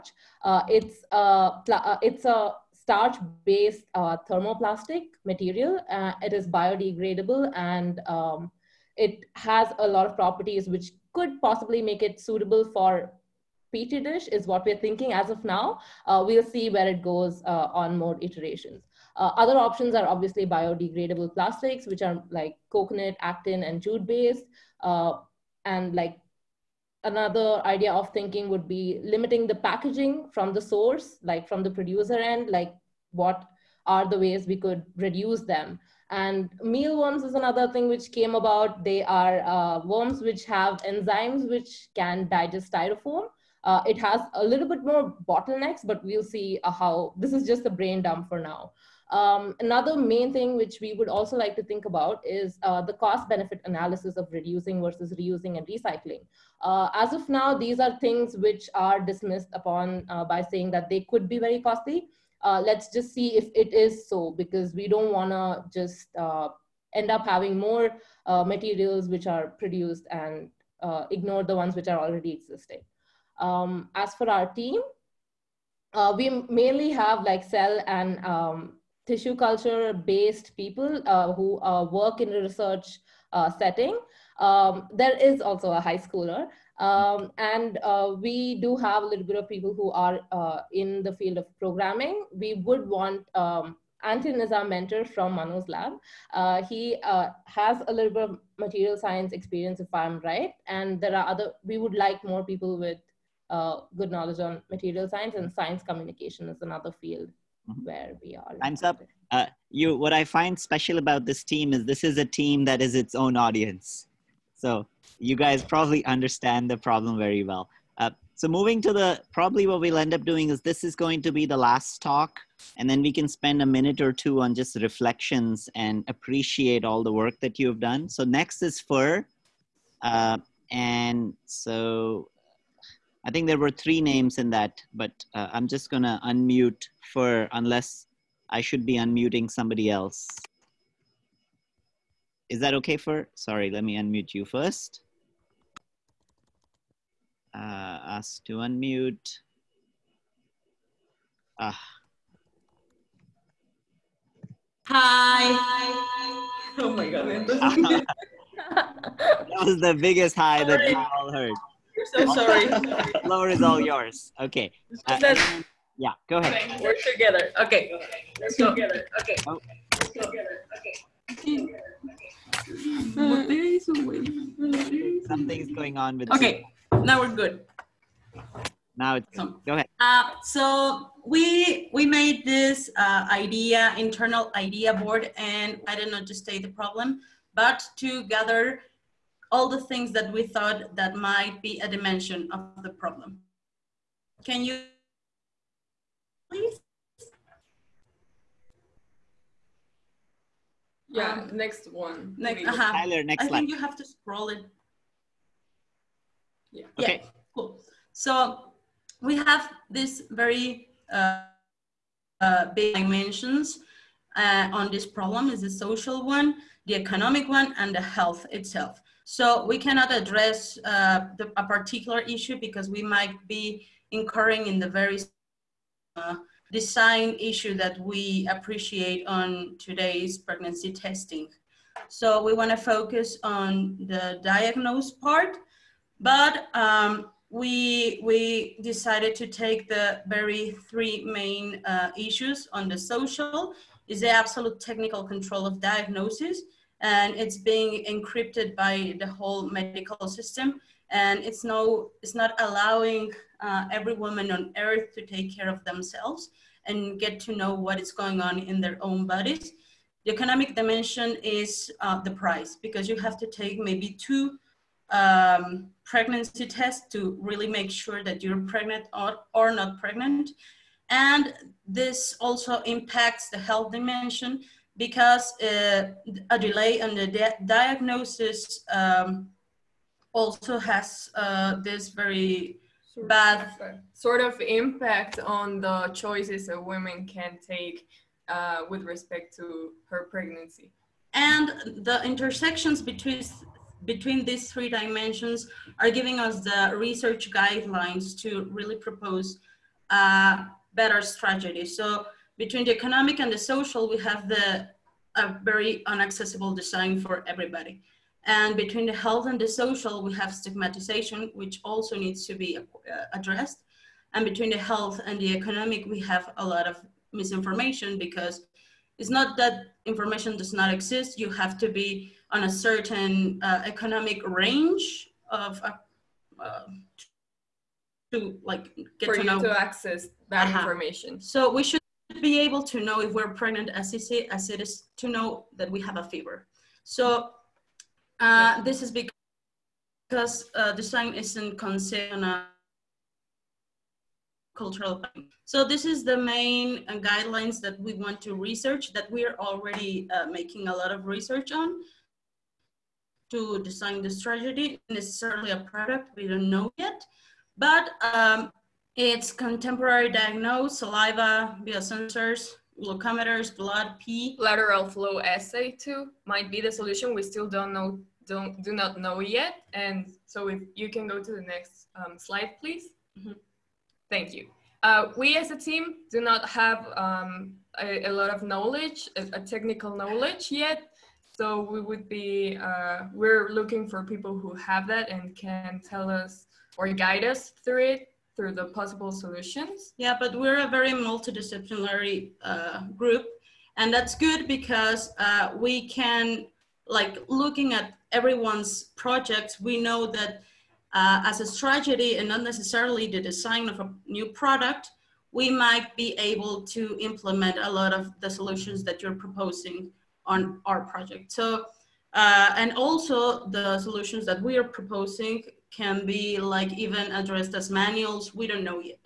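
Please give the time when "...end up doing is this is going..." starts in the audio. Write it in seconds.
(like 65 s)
119 s.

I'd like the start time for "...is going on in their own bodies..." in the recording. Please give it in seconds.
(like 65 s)
257 s.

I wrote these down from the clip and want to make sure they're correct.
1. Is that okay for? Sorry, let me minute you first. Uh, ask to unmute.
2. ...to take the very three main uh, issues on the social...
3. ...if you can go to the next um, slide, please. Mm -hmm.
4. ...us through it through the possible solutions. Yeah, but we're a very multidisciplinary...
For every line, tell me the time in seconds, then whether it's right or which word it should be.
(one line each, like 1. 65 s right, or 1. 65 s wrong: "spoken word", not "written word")
1. 142 s wrong: "unmute", not "minute"
2. 239 s right
3. 370 s right
4. 387 s right.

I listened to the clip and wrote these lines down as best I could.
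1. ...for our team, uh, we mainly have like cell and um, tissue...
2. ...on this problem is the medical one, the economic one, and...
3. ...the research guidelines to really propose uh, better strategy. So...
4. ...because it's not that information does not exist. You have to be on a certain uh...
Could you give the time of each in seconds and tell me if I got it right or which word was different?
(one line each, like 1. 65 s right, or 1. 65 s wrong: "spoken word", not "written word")
1. 74 s right
2. 214 s wrong: "social", not "medical"
3. 296 s right
4. 318 s right.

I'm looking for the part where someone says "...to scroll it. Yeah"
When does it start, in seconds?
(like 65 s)
204 s.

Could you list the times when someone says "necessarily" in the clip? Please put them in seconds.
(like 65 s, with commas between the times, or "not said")
355 s, 402 s.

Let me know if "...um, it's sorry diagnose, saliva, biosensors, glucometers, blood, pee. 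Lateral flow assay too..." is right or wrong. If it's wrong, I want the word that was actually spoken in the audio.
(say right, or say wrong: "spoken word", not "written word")
wrong: "contemporary", not "sorry".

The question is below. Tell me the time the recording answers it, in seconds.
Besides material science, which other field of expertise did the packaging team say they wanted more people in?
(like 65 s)
105 s.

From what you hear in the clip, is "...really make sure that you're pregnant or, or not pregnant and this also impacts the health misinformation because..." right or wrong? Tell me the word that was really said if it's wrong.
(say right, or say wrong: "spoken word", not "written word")
wrong: "dimension", not "misinformation".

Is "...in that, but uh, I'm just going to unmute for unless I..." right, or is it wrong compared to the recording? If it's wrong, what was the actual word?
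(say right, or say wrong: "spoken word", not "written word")
right.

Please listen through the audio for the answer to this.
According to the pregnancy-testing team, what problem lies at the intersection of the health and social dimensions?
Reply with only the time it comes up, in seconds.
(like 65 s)
310 s.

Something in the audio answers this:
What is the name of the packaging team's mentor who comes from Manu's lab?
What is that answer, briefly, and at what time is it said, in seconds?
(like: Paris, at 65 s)
Anton, at 94 s.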